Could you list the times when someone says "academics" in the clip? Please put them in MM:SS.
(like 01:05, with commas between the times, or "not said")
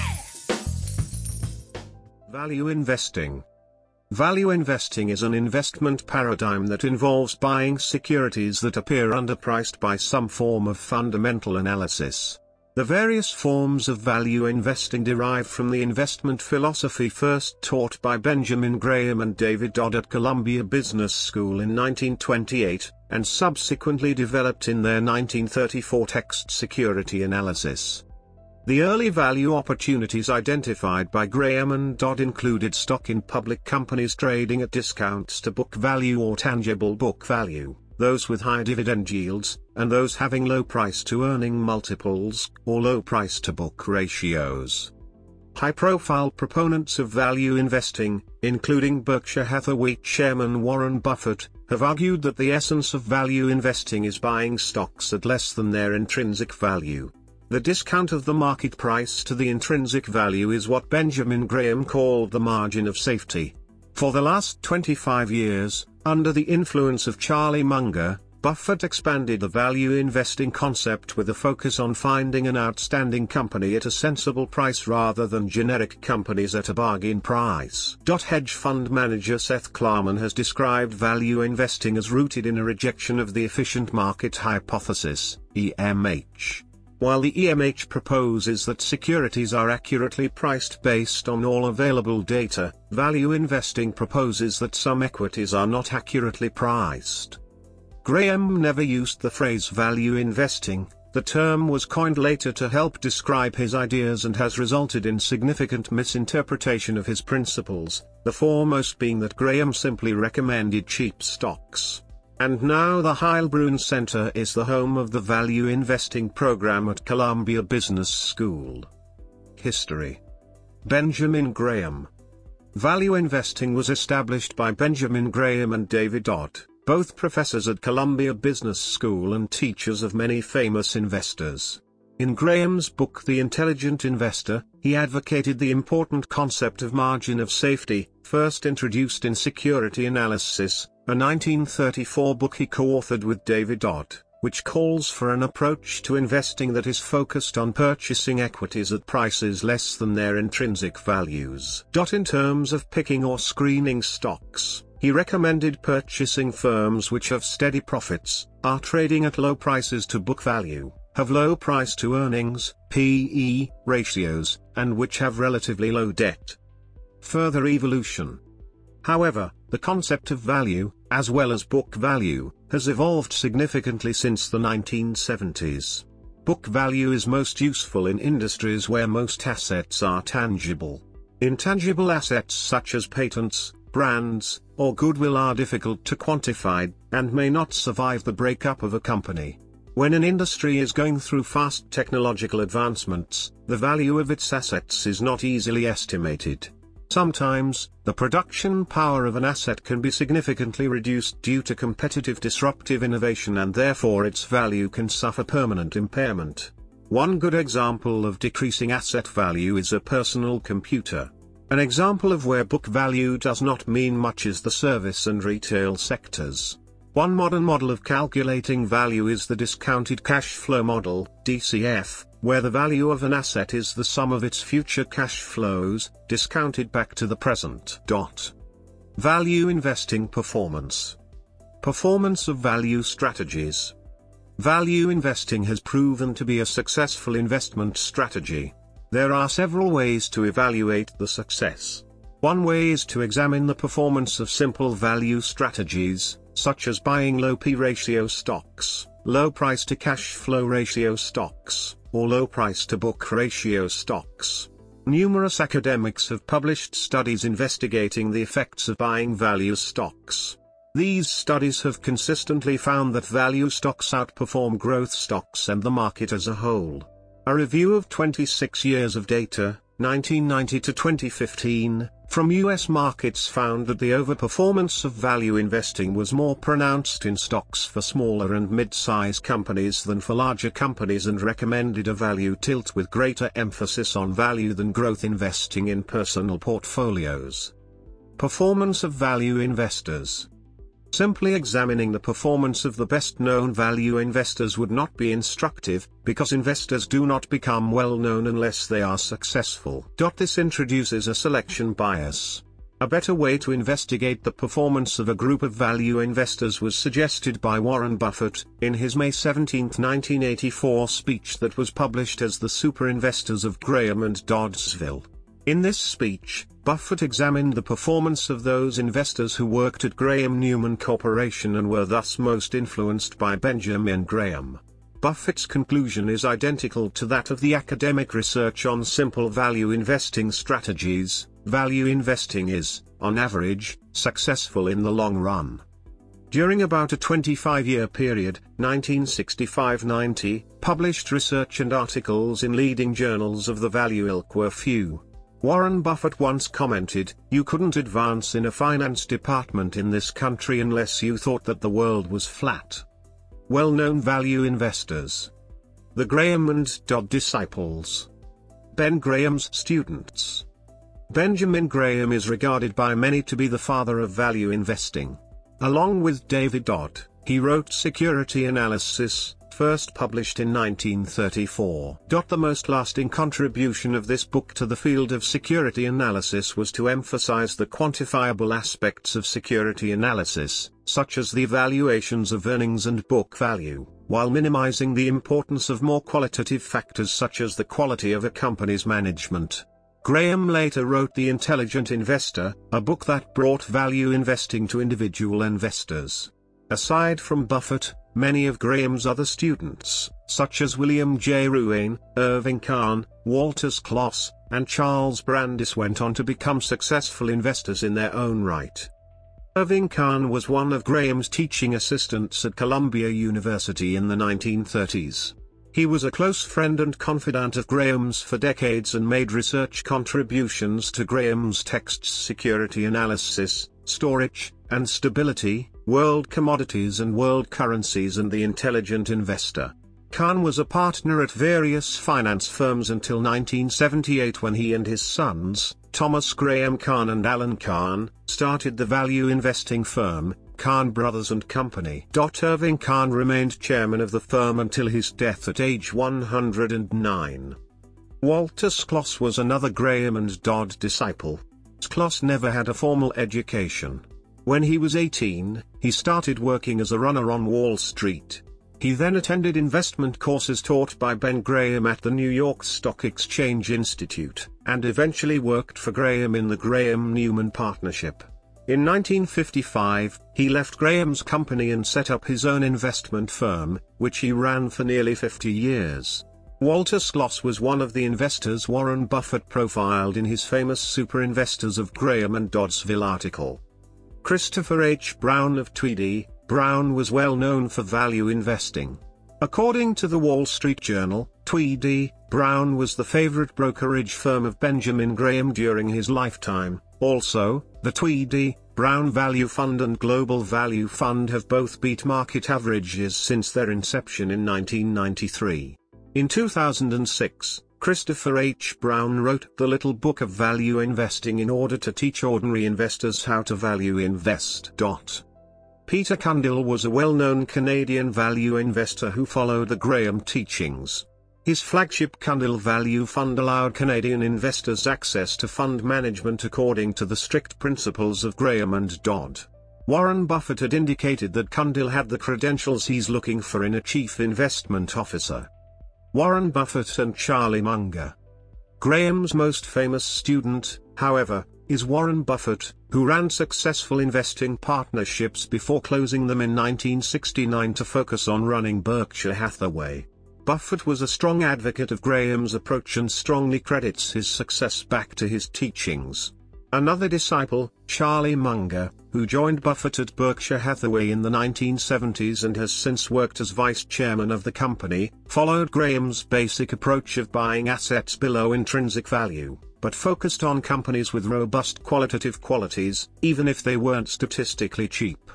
04:15, 05:27.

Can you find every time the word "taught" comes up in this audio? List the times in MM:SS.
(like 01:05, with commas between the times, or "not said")
00:17, 07:40.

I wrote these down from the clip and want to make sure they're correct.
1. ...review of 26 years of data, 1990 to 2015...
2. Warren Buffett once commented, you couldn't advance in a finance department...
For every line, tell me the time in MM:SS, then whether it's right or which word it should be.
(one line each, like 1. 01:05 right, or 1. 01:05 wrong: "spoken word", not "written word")
1. 04:27 right
2. 05:45 right.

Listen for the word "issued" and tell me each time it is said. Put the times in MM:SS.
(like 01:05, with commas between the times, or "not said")
not said.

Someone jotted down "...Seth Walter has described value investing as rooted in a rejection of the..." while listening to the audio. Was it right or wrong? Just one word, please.
wrong.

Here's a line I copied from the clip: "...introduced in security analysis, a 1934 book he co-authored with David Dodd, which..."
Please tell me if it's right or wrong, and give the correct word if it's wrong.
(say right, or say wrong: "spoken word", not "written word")
right.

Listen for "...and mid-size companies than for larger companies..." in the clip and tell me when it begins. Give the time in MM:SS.
04:38.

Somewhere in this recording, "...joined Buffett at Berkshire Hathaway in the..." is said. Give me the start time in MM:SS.
09:19.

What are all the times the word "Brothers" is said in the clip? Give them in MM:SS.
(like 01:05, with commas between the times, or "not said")
07:21.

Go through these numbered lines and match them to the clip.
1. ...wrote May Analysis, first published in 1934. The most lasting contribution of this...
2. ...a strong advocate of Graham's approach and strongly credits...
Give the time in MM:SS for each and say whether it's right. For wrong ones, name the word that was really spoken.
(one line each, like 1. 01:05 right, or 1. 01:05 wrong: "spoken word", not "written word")
1. 06:07 wrong: "Security", not "May"
2. 09:11 right.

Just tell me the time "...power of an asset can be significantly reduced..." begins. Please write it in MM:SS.
03:18.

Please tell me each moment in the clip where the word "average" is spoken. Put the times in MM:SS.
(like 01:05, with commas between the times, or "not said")
05:33, 08:22.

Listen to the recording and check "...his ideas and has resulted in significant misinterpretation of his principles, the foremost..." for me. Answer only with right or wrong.
right.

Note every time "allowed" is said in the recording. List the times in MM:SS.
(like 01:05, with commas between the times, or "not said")
08:43.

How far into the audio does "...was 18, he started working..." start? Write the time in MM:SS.
07:34.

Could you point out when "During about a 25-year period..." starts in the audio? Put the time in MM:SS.
05:36.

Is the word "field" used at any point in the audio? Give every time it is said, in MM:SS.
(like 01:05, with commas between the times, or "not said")
06:14.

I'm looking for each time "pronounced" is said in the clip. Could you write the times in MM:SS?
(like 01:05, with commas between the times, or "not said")
04:36.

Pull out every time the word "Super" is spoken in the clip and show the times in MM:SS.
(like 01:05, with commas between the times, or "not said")
05:12, 08:00.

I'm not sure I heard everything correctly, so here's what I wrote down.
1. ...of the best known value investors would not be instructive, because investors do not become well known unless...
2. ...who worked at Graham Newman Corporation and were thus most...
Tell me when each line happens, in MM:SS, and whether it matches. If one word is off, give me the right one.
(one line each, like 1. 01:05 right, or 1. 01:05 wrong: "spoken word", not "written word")
1. 04:52 right
2. 05:19 right.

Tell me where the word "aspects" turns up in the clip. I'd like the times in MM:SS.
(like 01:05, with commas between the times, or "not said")
06:18.